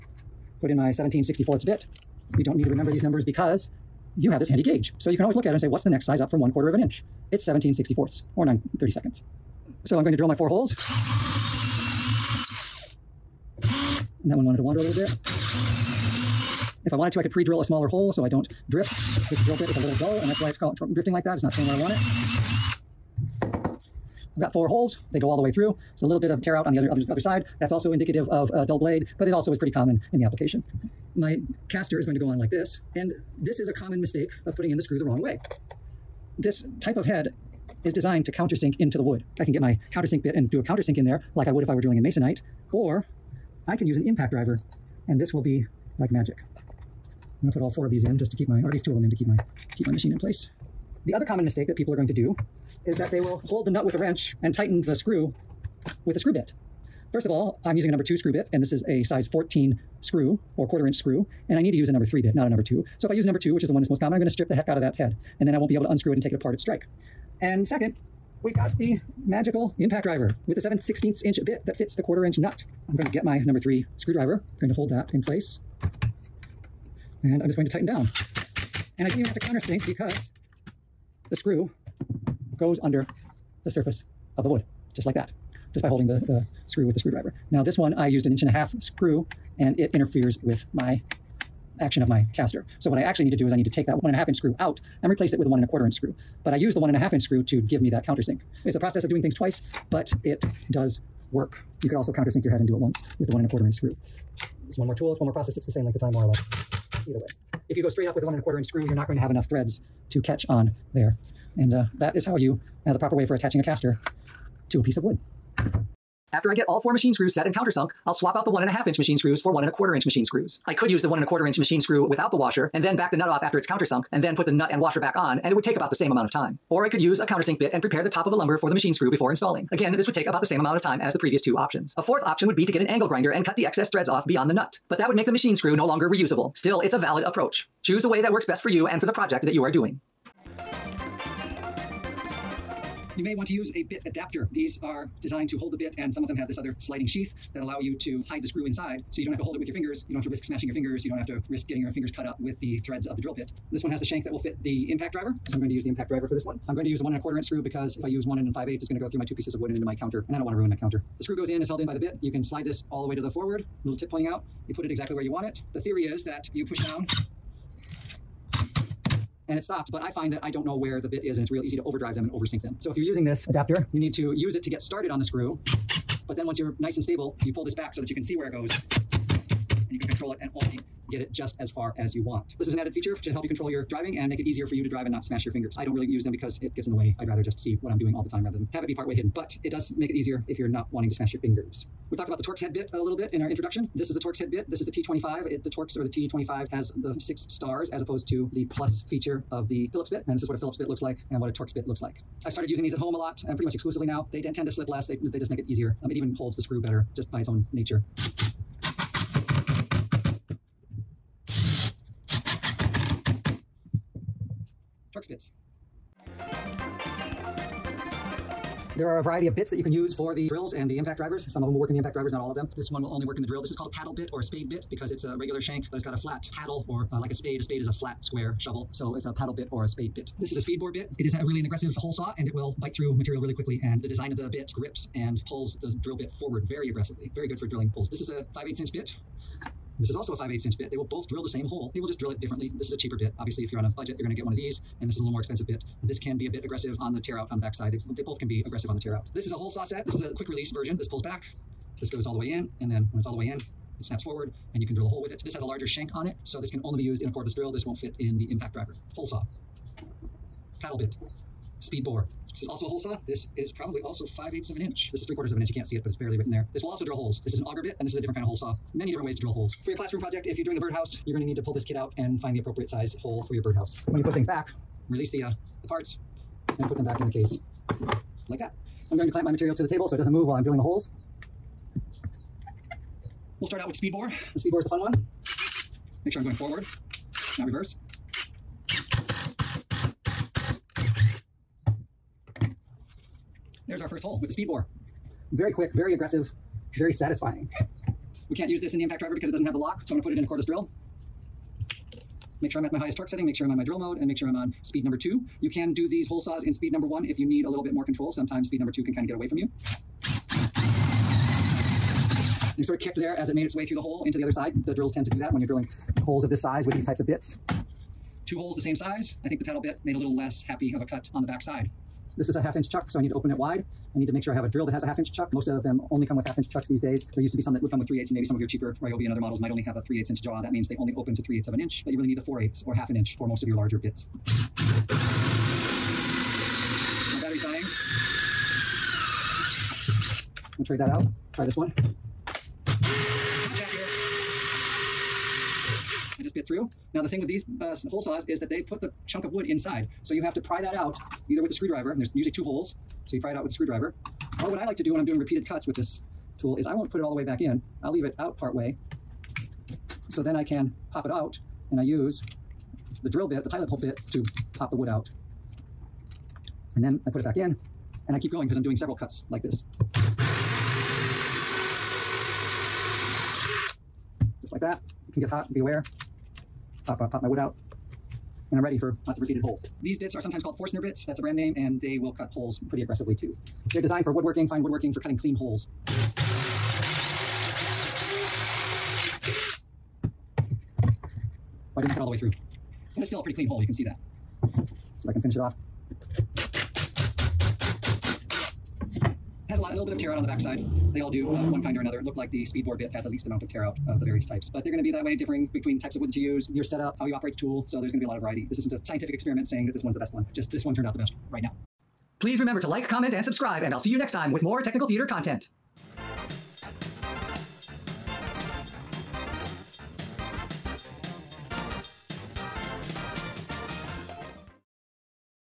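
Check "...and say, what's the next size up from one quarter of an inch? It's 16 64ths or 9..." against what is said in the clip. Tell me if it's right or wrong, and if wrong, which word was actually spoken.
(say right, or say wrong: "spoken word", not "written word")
wrong: "17", not "16".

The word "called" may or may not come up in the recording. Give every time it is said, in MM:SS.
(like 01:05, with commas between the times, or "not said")
00:20, 03:43, 06:20.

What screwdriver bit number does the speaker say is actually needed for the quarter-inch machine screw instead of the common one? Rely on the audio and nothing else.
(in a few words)
number 3.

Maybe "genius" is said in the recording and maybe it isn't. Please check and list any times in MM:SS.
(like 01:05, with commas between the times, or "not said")
not said.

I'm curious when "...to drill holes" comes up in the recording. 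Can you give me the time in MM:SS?
04:29.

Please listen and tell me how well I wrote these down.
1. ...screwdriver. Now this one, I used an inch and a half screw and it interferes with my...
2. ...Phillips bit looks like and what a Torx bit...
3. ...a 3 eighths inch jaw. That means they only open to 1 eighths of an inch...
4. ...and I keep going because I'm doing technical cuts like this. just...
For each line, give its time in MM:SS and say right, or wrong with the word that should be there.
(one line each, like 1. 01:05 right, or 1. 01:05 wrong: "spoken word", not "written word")
1. 01:26 right
2. 03:20 right
3. 05:29 wrong: "3", not "1"
4. 06:08 wrong: "several", not "technical".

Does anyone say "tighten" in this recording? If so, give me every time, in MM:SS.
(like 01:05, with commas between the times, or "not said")
00:54, 01:17.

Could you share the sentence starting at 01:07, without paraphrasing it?
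And second, we've got the magical impact driver with the 7 16th inch bit that fits the quarter inch nut.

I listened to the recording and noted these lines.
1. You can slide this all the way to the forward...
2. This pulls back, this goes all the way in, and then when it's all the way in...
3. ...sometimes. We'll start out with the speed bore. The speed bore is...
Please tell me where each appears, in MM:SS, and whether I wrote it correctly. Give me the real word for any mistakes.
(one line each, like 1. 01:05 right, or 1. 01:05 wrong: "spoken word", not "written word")
1. 02:42 right
2. 04:10 right
3. 04:40 wrong: "holes", not "sometimes".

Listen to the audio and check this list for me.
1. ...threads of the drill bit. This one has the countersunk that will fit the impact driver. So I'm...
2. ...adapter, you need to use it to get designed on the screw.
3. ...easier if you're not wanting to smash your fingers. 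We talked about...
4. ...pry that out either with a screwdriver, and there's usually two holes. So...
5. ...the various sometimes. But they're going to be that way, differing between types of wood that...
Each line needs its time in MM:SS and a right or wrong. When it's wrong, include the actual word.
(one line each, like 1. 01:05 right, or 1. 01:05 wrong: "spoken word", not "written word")
1. 02:32 wrong: "shank", not "countersunk"
2. 02:53 wrong: "started", not "designed"
3. 03:10 right
4. 05:50 right
5. 06:44 wrong: "types", not "sometimes".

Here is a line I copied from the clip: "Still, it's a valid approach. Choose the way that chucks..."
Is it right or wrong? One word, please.
wrong.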